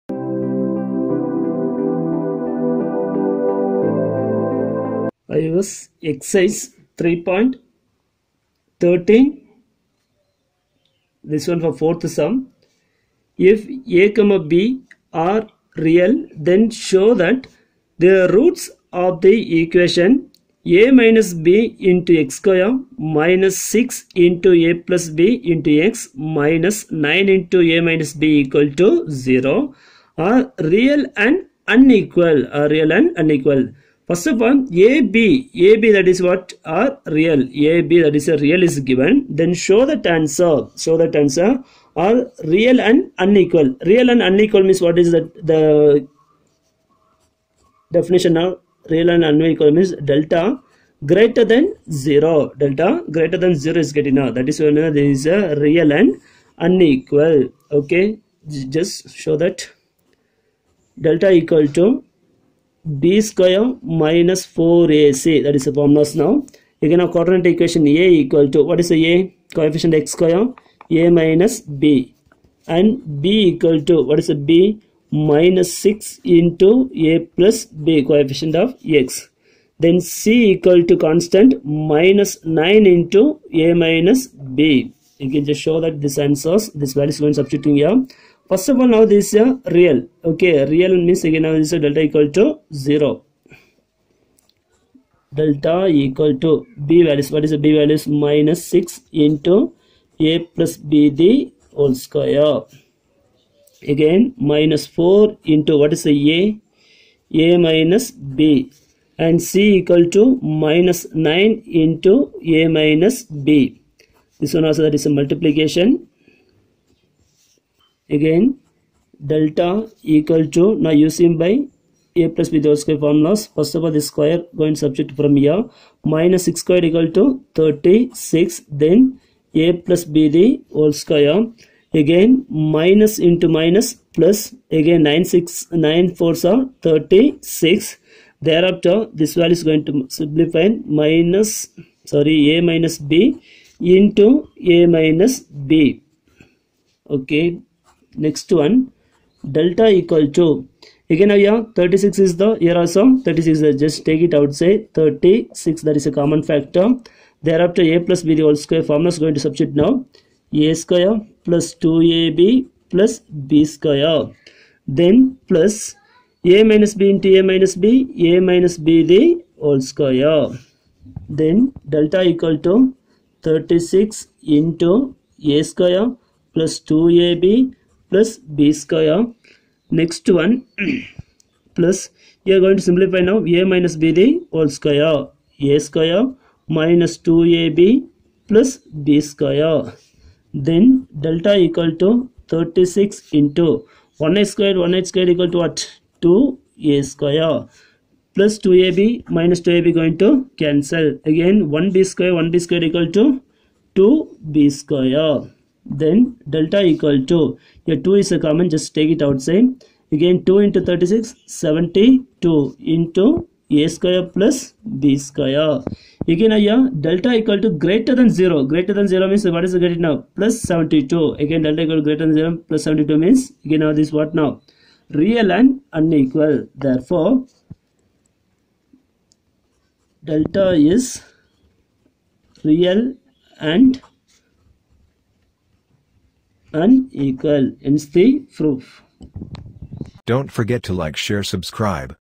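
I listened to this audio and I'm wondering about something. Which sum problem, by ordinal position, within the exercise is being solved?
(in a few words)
Fourth.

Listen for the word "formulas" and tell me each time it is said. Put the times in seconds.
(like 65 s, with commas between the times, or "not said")
65 s, 123 s, 158 s.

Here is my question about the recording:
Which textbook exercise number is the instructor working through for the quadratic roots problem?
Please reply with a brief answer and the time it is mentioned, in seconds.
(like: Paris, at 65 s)
3.13, at 6 s.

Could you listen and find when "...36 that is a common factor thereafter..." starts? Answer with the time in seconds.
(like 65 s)
154 s.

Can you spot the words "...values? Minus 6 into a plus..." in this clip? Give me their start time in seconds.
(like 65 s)
97 s.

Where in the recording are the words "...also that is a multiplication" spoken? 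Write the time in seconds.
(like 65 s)
114 s.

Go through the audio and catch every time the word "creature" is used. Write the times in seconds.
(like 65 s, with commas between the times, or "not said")
not said.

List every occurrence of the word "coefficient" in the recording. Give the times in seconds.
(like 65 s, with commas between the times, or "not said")
69 s, 78 s.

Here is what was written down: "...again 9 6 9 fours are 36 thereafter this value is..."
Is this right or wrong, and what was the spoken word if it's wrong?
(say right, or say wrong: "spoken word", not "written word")
right.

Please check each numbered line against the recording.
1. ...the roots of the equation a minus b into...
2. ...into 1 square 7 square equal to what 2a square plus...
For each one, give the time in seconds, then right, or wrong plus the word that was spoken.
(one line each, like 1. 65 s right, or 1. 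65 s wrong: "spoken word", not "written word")
1. 18 s right
2. 193 s wrong: "1", not "7".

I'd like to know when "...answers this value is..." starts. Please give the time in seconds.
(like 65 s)
86 s.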